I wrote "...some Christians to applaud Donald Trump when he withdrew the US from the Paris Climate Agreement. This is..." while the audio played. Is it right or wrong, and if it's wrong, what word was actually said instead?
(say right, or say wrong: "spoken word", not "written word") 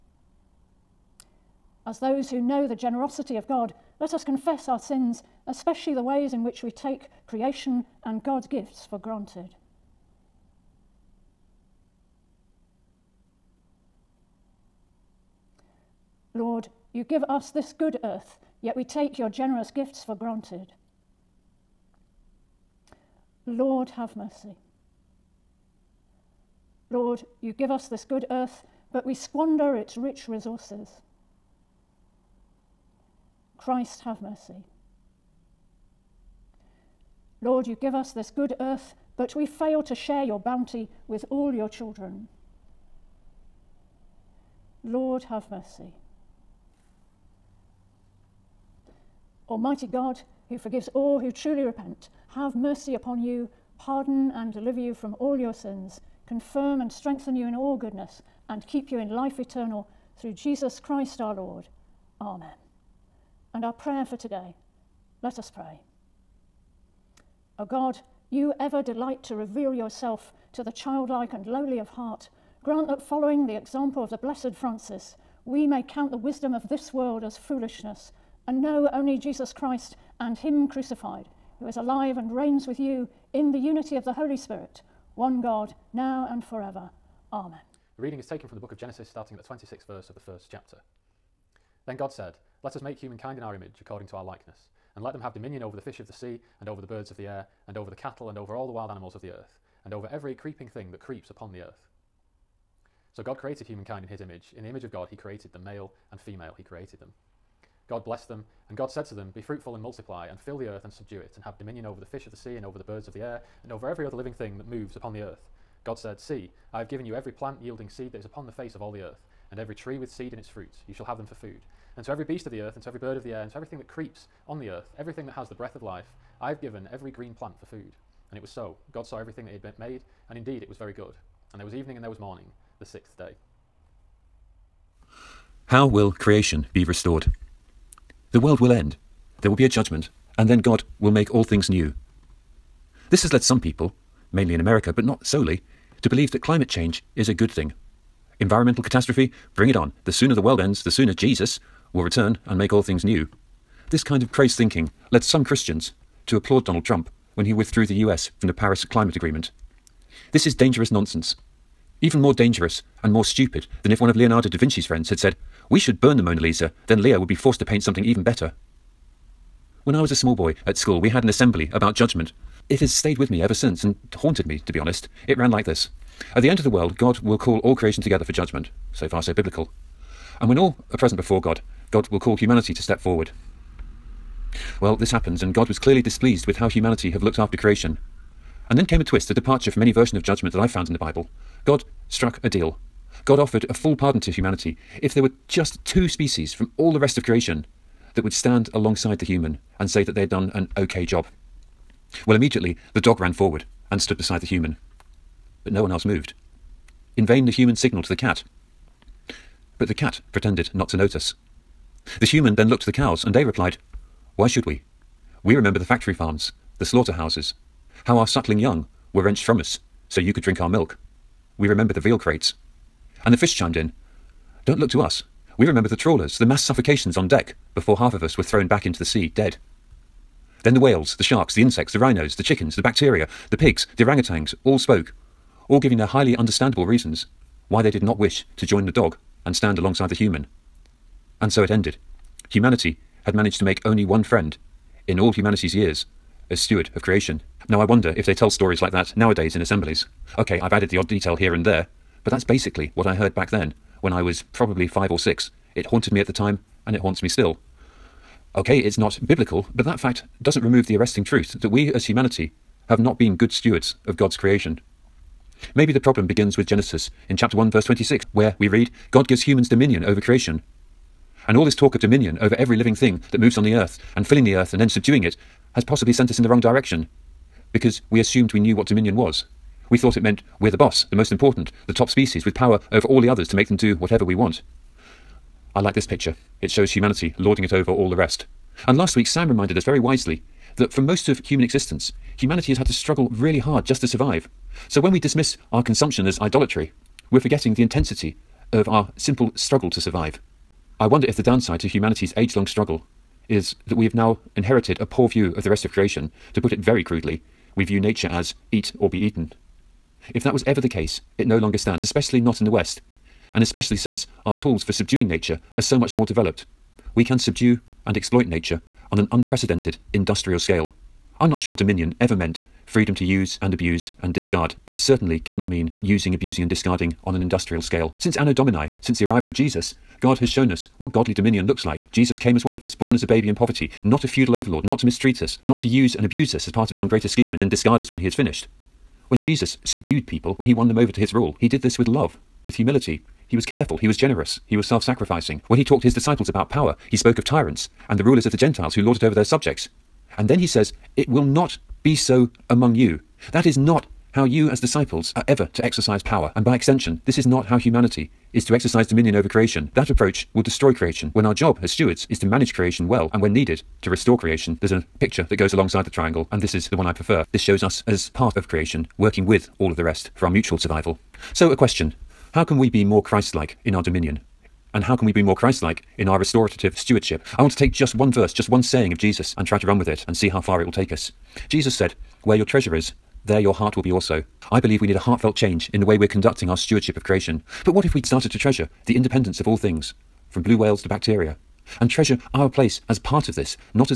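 right.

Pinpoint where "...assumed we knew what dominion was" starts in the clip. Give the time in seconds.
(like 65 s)
278 s.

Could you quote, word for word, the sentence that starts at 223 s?
And the fish chimed in Don't look to us.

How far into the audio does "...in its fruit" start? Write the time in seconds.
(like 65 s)
120 s.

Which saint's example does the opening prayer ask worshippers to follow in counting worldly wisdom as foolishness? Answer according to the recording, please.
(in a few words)
Francis.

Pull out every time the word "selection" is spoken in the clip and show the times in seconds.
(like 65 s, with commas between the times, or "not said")
not said.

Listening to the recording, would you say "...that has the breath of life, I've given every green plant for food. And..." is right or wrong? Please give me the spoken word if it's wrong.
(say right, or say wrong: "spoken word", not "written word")
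right.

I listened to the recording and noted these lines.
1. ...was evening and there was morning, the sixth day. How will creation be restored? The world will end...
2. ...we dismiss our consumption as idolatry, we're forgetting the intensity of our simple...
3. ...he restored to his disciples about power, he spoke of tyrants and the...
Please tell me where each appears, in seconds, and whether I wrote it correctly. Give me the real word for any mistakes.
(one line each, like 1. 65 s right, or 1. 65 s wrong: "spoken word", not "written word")
1. 131 s right
2. 295 s right
3. 345 s wrong: "talked", not "restored".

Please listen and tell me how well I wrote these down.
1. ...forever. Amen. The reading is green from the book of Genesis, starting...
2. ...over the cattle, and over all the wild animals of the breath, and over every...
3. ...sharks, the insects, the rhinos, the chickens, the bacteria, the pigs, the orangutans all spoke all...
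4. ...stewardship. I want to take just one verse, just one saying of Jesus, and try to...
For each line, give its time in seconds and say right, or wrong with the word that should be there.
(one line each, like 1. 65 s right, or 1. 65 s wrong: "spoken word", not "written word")
1. 86 s wrong: "taken", not "green"
2. 97 s wrong: "earth", not "breath"
3. 231 s right
4. 376 s right.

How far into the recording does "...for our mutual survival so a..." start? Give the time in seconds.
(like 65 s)
370 s.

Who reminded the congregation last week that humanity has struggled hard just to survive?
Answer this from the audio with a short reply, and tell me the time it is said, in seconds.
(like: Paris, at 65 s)
Sam, at 289 s.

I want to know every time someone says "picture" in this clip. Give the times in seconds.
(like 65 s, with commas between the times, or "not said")
286 s, 365 s.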